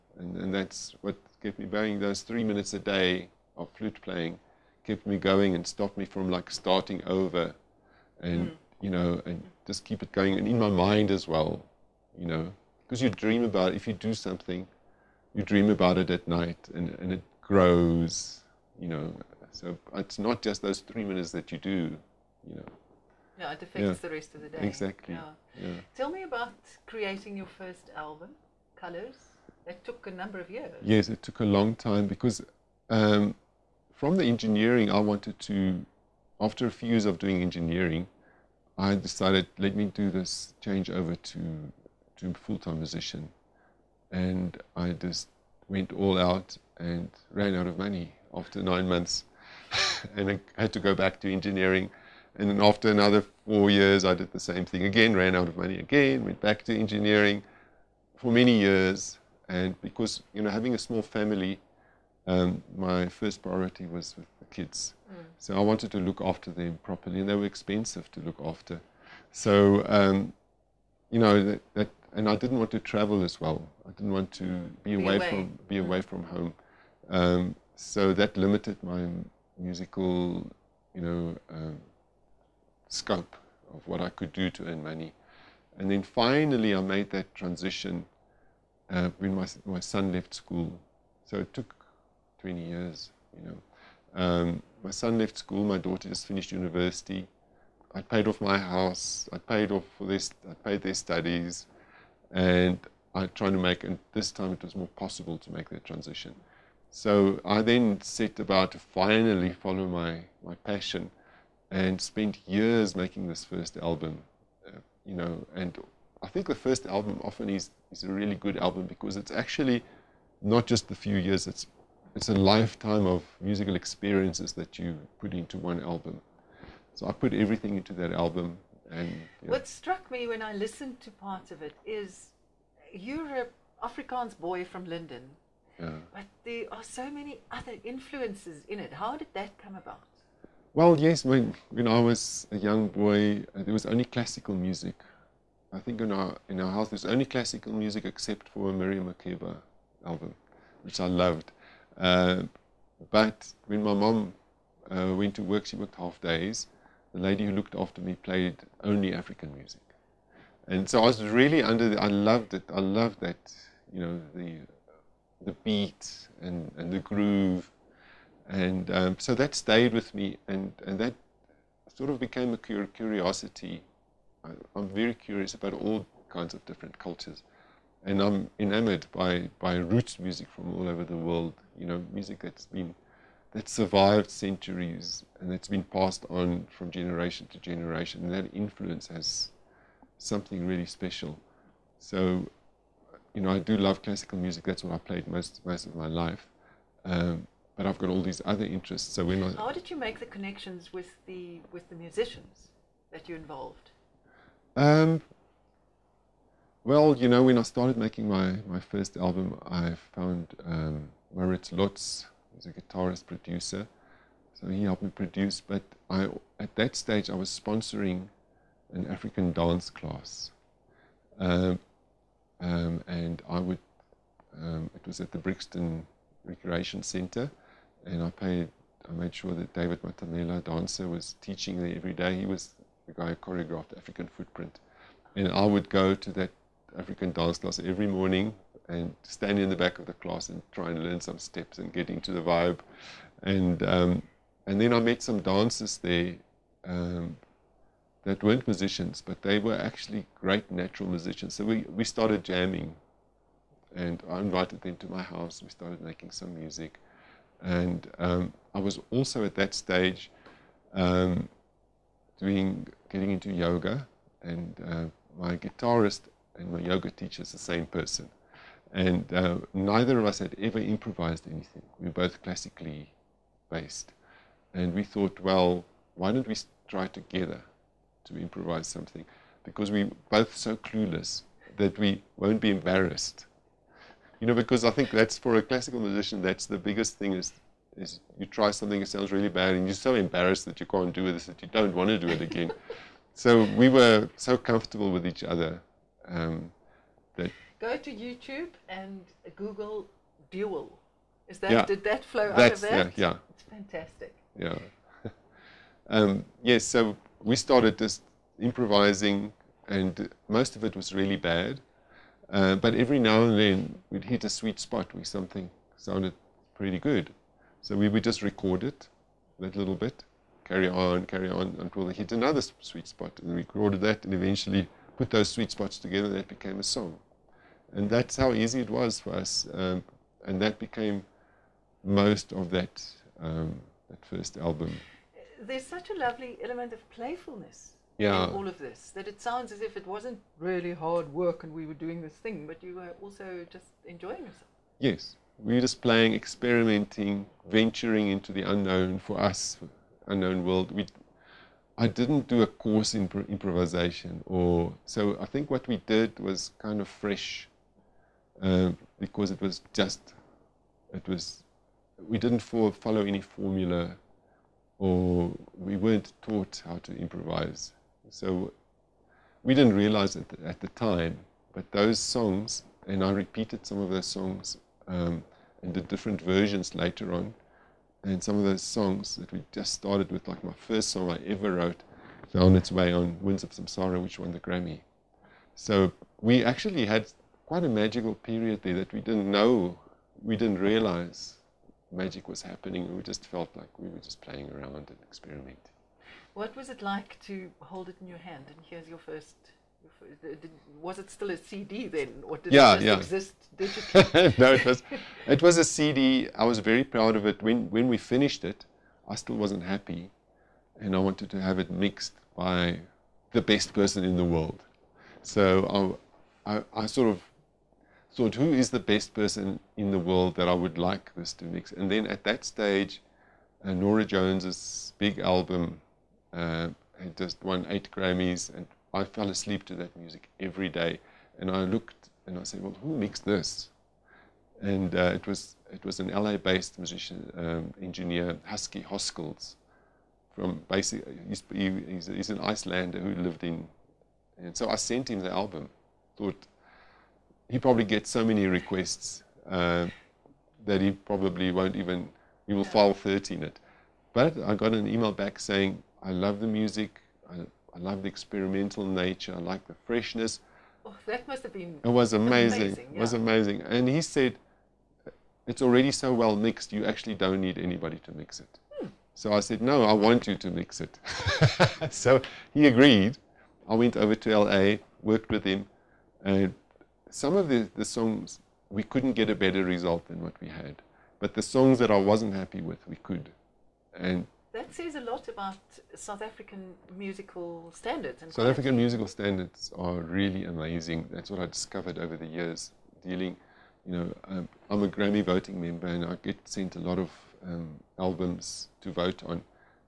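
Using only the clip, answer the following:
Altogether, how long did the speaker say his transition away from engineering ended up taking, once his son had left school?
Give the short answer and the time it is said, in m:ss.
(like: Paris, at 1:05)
20 years, at 1:32.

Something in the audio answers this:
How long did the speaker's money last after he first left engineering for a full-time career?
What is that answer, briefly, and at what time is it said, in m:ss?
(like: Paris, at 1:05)
9 months, at 0:48.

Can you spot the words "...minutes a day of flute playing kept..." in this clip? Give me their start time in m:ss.
0:02.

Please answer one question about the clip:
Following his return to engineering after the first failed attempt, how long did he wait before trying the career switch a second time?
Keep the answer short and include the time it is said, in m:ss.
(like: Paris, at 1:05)
4 years, at 0:53.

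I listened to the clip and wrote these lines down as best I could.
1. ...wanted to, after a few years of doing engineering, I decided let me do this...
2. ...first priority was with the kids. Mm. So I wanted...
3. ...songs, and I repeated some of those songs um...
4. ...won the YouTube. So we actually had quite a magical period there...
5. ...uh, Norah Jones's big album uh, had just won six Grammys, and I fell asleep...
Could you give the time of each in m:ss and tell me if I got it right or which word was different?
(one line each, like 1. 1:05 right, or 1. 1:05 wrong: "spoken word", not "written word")
1. 0:34 right
2. 1:03 right
3. 6:12 right
4. 6:24 wrong: "Grammy", not "YouTube"
5. 7:03 wrong: "eight", not "six".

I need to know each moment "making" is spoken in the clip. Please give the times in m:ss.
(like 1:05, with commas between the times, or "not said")
1:52, 3:27, 4:16.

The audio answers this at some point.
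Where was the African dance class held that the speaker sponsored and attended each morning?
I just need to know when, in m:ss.
3:45.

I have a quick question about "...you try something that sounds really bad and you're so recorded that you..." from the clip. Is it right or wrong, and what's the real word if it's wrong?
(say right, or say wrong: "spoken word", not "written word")
wrong: "embarrassed", not "recorded".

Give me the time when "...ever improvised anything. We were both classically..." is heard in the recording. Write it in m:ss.
4:30.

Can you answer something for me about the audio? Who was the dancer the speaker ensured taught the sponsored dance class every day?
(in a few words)
David Matamela.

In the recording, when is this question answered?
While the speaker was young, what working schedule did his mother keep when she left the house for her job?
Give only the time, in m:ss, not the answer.
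2:35.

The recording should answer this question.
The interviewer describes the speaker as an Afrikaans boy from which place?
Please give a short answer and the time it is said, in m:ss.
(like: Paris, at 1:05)
Linden, at 2:14.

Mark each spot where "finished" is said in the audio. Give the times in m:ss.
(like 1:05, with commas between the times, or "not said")
1:36, 6:48.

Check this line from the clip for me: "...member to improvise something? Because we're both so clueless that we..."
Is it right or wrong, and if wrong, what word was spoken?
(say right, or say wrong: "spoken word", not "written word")
wrong: "together", not "member".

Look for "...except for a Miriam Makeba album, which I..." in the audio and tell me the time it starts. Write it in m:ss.
2:28.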